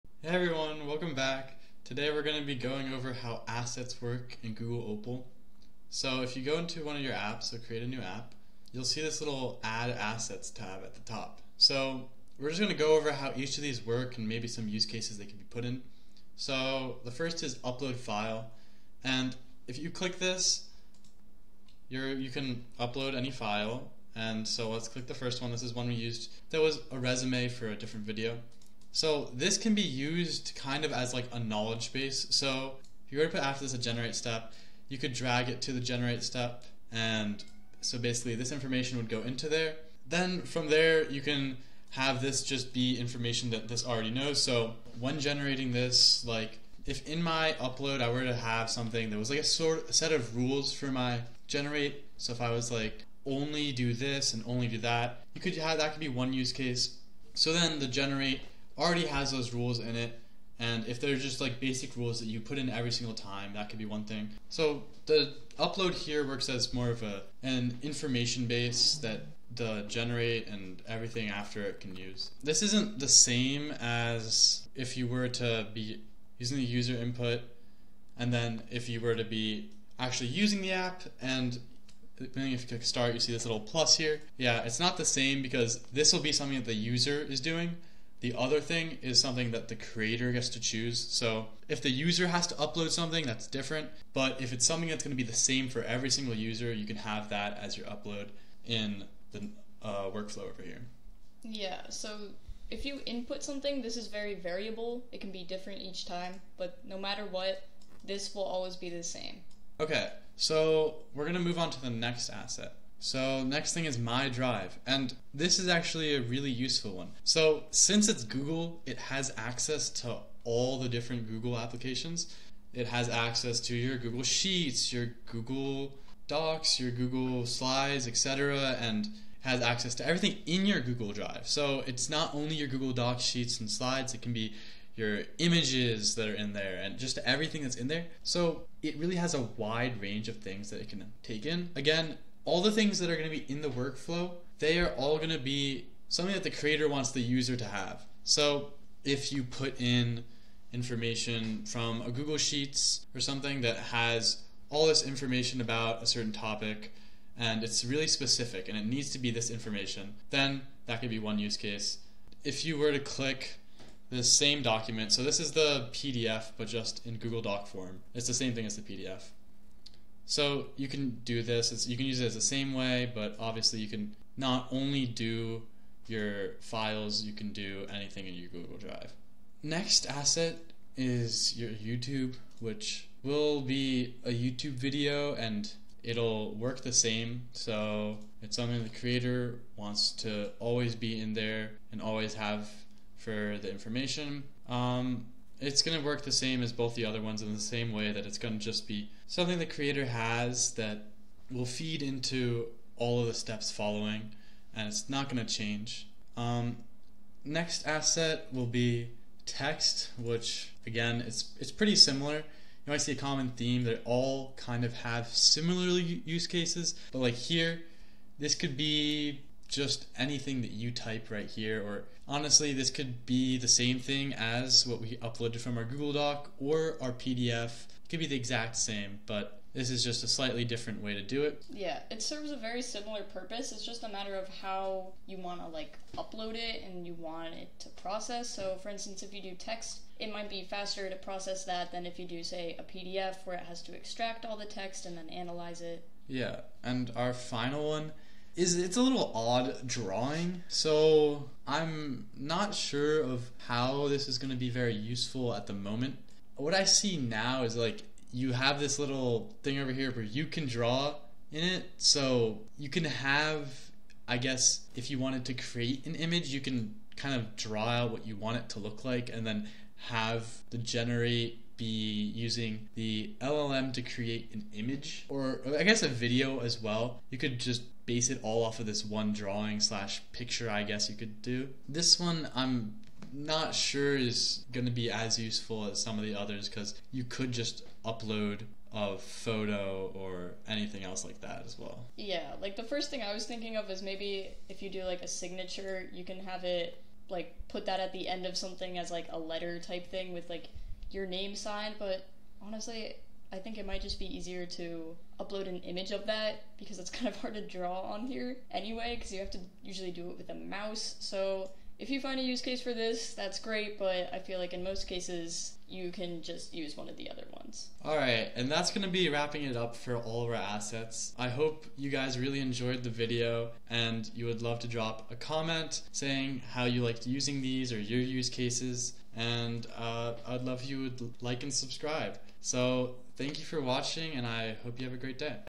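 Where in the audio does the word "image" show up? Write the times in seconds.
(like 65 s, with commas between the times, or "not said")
135 s, 266 s, 274 s, 305 s.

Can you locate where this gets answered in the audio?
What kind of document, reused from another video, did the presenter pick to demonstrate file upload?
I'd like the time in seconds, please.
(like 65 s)
26 s.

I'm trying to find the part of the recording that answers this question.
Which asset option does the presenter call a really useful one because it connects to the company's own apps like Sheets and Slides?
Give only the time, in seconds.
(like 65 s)
113 s.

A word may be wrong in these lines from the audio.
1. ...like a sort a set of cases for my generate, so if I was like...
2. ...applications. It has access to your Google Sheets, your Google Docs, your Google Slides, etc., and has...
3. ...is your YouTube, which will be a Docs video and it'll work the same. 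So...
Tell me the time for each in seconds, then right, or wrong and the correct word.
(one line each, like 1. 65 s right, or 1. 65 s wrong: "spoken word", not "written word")
1. 49 s wrong: "rules", not "cases"
2. 121 s right
3. 180 s wrong: "YouTube", not "Docs".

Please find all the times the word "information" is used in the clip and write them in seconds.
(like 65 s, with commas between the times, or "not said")
38 s, 42 s, 67 s, 150 s, 155 s, 159 s, 193 s.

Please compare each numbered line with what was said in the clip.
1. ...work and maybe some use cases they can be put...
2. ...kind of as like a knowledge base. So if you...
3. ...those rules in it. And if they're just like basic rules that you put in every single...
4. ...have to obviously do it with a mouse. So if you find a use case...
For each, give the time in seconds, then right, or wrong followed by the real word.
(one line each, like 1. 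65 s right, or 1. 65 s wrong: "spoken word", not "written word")
1. 13 s right
2. 30 s right
3. 59 s right
4. 309 s wrong: "usually", not "obviously".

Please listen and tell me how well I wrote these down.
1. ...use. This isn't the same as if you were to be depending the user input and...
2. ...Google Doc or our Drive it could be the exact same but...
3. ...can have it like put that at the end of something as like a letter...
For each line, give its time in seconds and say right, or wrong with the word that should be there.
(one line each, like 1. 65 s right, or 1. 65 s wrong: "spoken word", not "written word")
1. 71 s wrong: "using", not "depending"
2. 225 s wrong: "PDF", not "Drive"
3. 296 s right.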